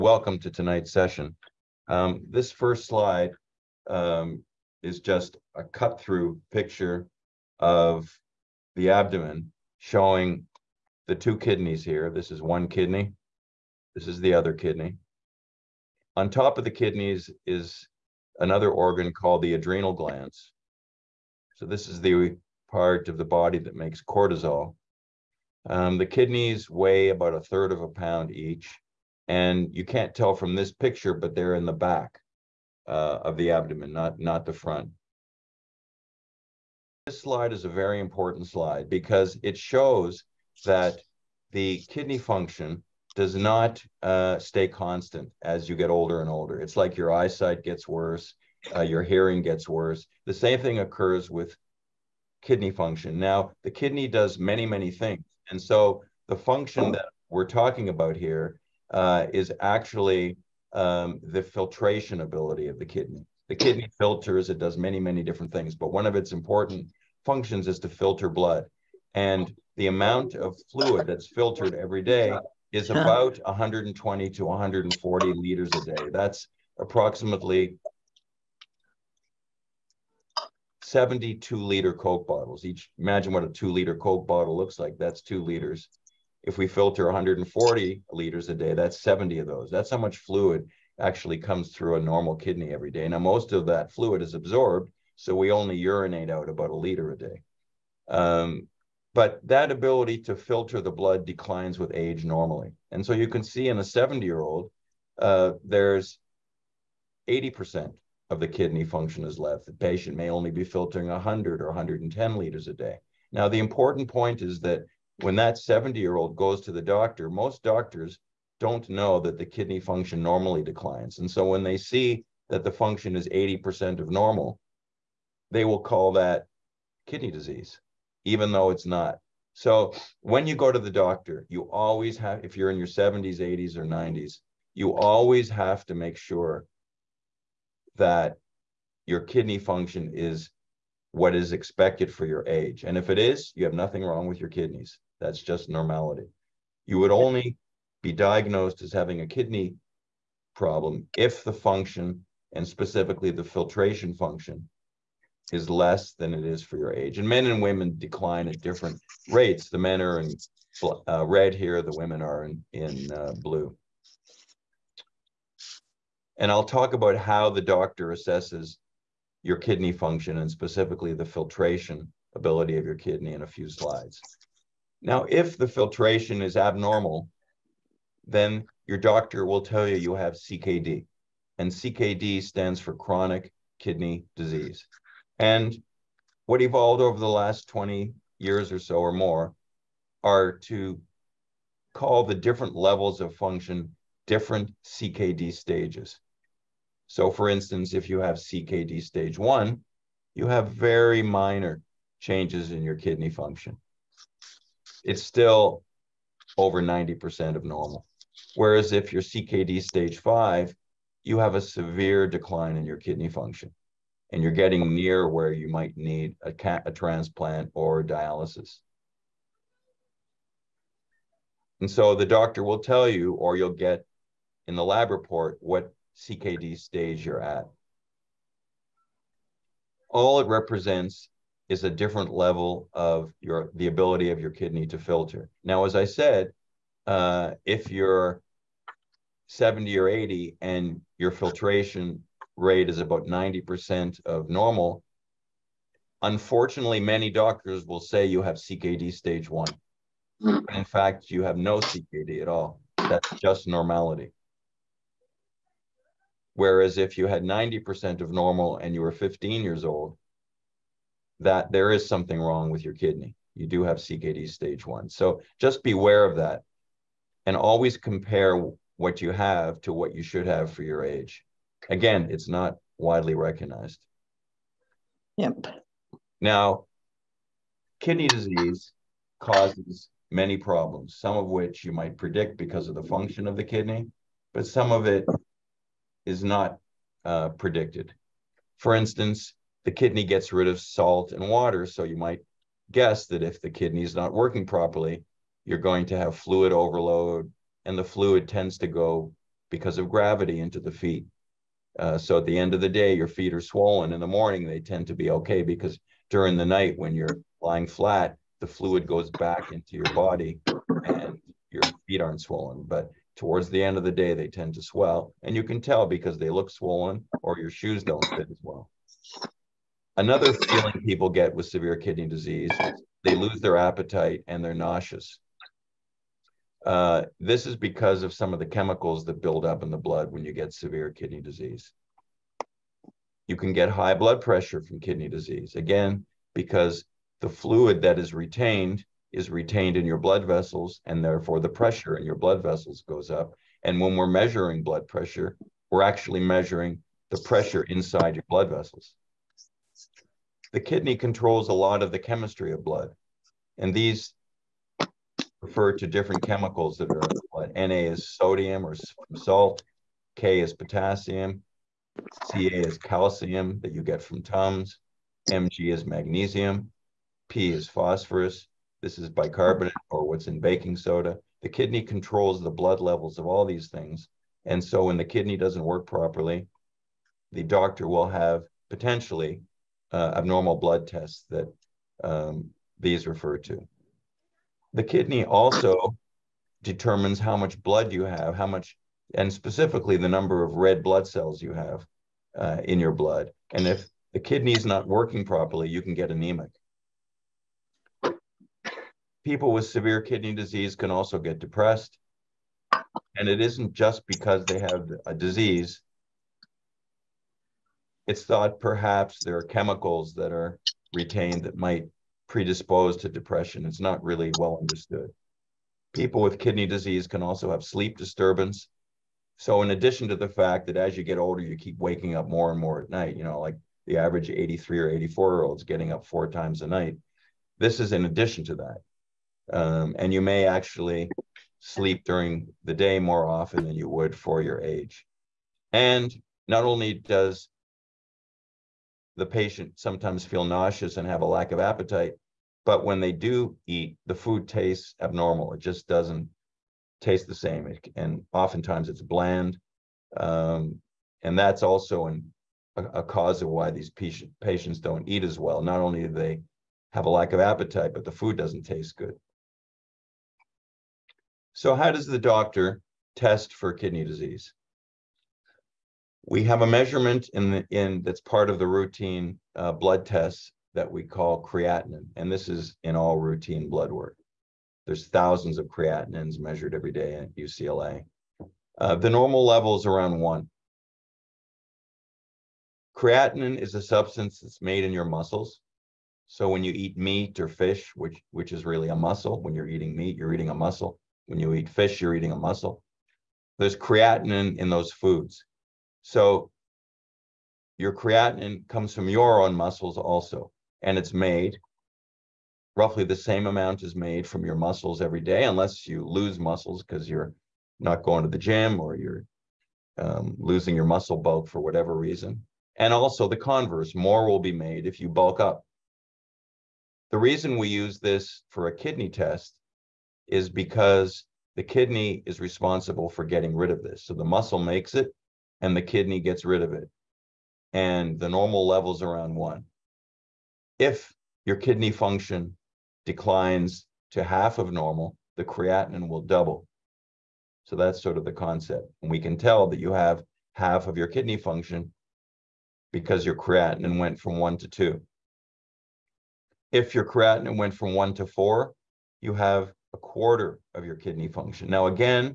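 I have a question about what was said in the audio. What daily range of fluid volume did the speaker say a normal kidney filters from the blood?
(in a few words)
120 to 140 liters.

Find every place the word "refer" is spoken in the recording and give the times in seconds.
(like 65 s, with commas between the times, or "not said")
355 s, 383 s.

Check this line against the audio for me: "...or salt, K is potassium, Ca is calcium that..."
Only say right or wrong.
right.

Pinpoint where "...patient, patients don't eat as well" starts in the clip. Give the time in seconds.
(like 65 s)
454 s.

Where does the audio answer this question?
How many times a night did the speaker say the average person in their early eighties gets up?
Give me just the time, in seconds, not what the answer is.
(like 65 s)
426 s.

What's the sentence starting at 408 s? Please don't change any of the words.
It's thought perhaps there are chemicals that are retained that might predisposed to depression.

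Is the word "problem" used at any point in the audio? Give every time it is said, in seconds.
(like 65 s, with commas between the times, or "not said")
150 s, 280 s.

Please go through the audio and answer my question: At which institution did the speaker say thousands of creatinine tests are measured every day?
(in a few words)
UCLA.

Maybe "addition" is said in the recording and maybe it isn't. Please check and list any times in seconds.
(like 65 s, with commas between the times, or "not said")
419 s, 428 s.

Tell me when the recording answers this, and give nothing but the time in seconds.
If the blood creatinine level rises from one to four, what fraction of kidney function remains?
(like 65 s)
550 s.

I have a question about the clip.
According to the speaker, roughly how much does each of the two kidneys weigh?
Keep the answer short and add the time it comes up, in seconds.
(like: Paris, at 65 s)
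a third of a pound, at 27 s.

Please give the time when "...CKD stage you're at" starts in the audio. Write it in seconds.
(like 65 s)
226 s.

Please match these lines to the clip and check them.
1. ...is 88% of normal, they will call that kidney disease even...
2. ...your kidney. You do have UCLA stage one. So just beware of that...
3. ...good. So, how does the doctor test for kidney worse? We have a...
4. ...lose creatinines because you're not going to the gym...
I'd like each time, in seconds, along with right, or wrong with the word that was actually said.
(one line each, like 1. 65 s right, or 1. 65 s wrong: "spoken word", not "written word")
1. 123 s wrong: "80", not "88"
2. 262 s wrong: "CKD", not "UCLA"
3. 459 s wrong: "disease", not "worse"
4. 506 s wrong: "muscles", not "creatinines".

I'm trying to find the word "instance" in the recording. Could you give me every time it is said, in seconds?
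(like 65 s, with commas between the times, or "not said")
197 s, 288 s.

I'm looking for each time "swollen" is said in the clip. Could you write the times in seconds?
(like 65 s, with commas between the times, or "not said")
303 s, 312 s, 316 s.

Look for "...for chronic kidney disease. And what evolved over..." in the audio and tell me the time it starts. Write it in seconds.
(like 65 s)
182 s.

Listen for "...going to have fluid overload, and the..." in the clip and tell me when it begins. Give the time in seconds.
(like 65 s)
295 s.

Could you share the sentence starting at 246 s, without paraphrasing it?
Unfortunately, many doctors will say you have CKD stage one.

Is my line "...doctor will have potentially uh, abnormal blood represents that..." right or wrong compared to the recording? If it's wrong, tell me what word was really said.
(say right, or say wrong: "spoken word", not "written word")
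wrong: "tests", not "represents".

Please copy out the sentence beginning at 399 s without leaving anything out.
People with severe kidney disease can also get depressed.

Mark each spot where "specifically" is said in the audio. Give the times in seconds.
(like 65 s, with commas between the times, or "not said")
152 s, 170 s, 389 s.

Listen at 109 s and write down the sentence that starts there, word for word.
The patient may only be filtering 100 or 110 liters a day.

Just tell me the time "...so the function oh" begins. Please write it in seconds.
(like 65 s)
55 s.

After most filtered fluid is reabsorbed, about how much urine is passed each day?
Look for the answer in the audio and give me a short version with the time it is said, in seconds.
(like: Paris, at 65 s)
about a liter, at 96 s.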